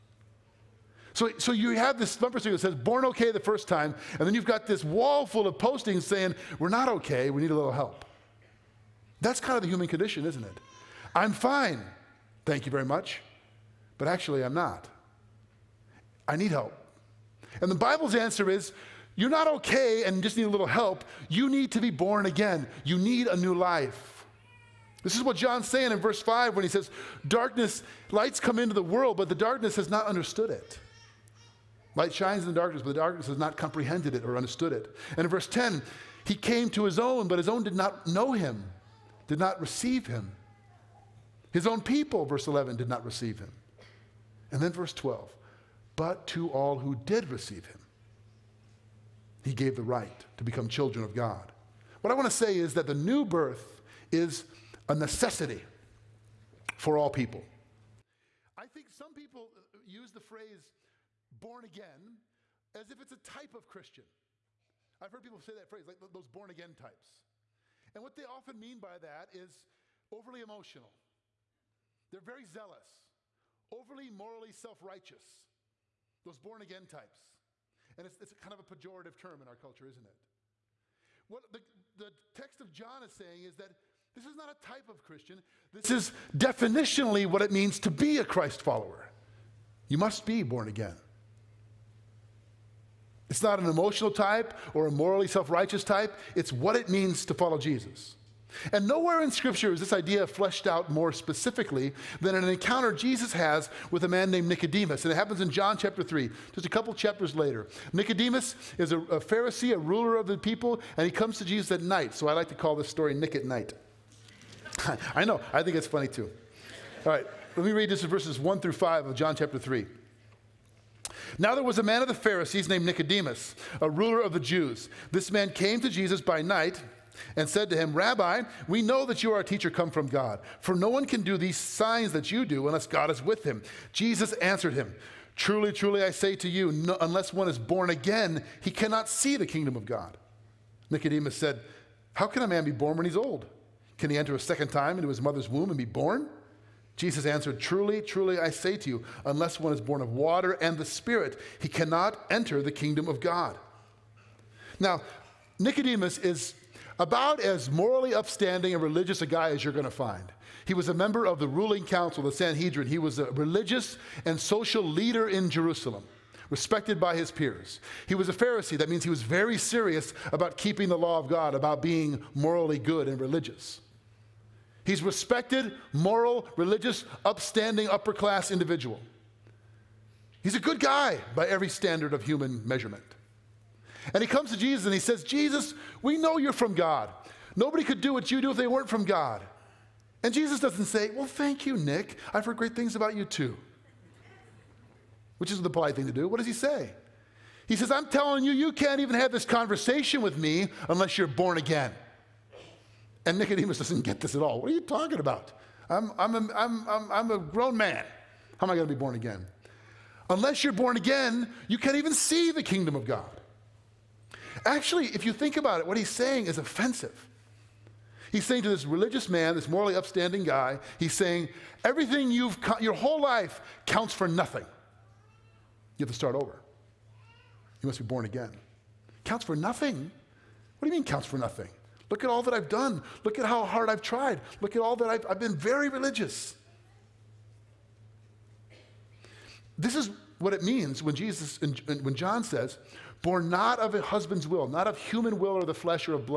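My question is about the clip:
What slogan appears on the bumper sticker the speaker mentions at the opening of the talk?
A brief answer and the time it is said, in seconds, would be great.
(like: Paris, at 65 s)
Born okay the first time, at 2 s.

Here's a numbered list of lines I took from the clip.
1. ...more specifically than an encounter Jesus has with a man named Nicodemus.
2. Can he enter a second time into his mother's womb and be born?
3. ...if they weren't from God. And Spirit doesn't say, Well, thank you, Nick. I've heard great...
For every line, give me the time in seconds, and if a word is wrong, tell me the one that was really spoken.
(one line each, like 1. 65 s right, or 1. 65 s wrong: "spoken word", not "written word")
1. 100 s right
2. 143 s right
3. 188 s wrong: "Jesus", not "Spirit".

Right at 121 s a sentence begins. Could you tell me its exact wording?
Now there was a man of the Pharisees named Nicodemus, a ruler of the Jews.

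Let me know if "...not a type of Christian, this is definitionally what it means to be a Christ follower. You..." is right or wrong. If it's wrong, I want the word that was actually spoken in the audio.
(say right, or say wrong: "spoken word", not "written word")
right.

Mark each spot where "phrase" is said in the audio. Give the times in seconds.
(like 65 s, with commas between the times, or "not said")
60 s, 65 s.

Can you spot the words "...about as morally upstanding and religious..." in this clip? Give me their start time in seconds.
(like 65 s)
156 s.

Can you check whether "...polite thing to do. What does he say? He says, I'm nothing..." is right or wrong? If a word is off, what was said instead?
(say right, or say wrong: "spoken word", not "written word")
wrong: "telling", not "nothing".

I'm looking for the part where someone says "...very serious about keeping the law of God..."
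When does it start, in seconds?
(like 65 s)
169 s.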